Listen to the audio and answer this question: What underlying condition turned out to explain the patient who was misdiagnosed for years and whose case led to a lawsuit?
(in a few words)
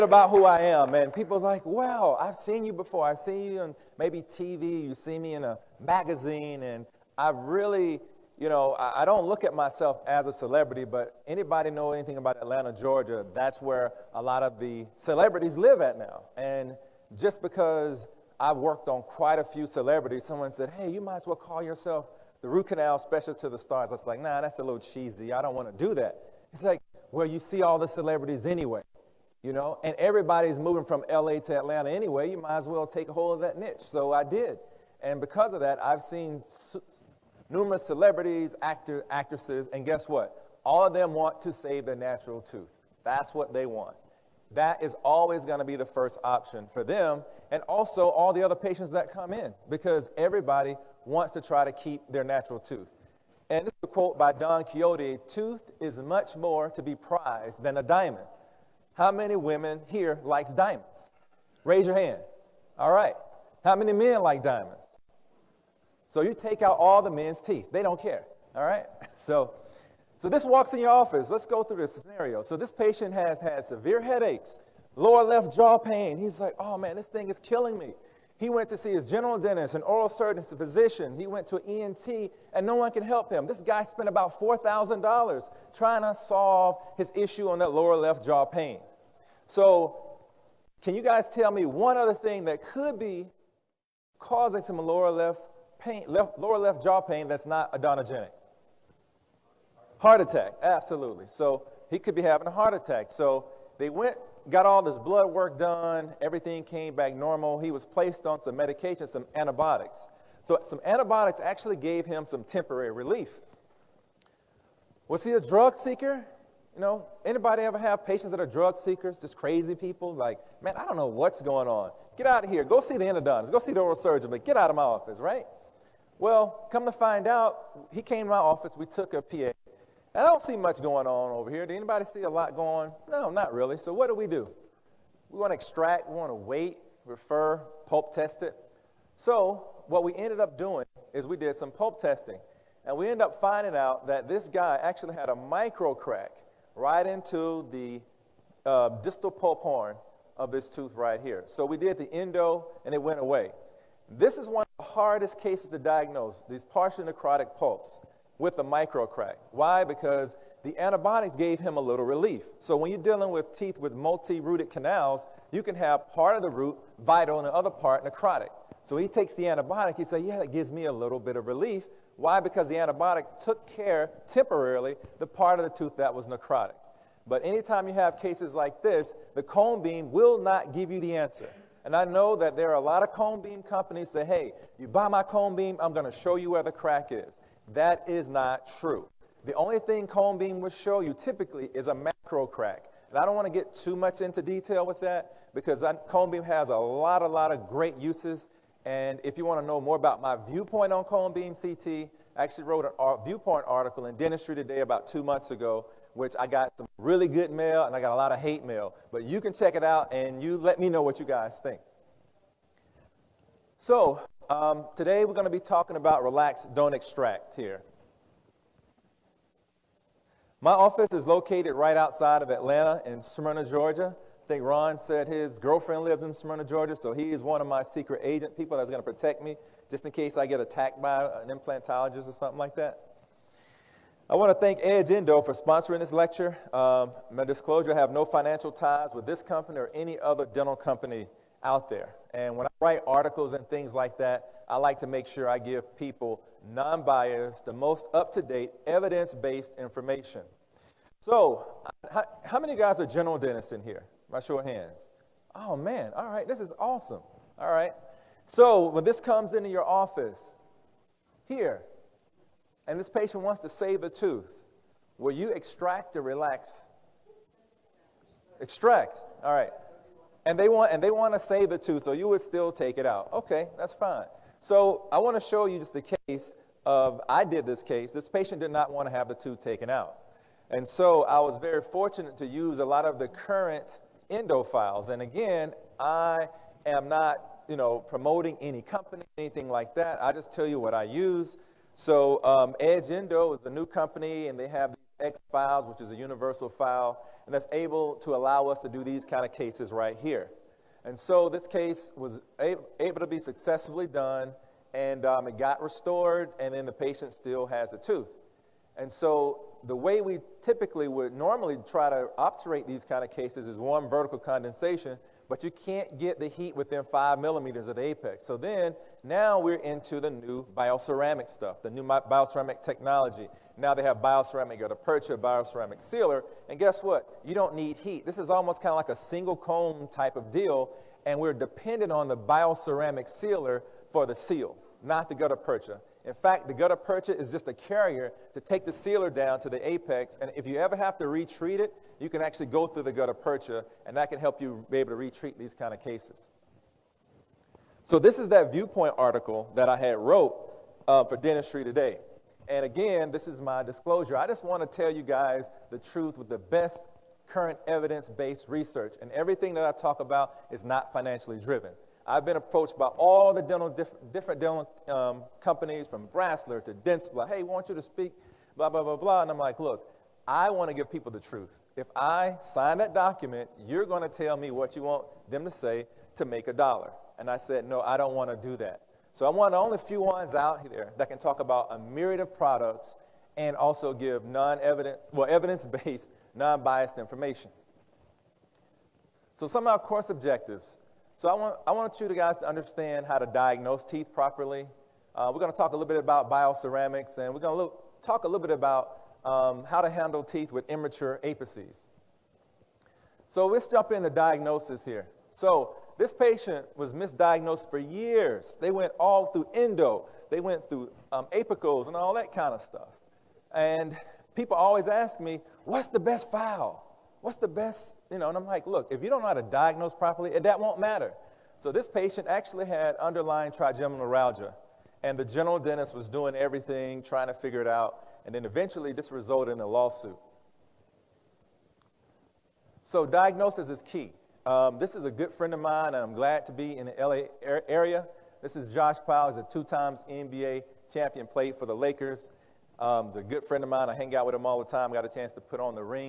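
Trigeminal neuralgia.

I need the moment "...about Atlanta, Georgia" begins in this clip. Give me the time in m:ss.
0:12.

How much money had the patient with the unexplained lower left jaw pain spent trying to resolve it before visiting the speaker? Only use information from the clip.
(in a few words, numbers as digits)
$4,000.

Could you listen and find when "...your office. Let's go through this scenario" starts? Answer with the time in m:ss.
1:10.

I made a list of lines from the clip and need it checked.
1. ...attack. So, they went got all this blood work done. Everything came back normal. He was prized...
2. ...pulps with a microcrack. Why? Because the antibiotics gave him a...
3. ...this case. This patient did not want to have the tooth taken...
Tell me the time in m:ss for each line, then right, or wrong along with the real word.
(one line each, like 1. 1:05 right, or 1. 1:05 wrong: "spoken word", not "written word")
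1. 1:42 wrong: "placed", not "prized"
2. 2:37 right
3. 4:37 right.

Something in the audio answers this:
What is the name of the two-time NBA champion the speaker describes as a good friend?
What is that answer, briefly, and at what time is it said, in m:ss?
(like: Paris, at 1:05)
Josh Powell, at 7:18.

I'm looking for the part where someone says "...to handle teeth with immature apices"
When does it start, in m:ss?
6:39.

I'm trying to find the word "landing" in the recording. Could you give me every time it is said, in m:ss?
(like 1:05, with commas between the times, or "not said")
not said.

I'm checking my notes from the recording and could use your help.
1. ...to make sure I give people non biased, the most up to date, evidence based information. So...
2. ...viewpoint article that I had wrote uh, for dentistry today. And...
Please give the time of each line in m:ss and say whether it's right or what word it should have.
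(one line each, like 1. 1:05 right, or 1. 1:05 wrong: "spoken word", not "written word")
1. 4:04 right
2. 5:48 right.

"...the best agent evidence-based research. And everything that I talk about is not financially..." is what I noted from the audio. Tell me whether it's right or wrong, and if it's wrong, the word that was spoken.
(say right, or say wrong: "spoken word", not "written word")
wrong: "current", not "agent".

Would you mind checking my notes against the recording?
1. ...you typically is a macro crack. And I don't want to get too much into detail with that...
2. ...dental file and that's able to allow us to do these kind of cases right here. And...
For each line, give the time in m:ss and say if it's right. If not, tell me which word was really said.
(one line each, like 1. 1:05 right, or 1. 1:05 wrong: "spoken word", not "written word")
1. 3:10 right
2. 4:56 wrong: "universal", not "dental".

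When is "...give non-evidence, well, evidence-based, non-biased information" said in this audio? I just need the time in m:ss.
6:24.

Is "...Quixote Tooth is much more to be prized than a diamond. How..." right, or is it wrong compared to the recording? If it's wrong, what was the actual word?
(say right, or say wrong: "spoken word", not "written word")
right.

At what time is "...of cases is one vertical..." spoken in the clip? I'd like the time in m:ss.
5:13.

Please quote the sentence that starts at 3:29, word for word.
But you can check it out and you let me know what you guys think.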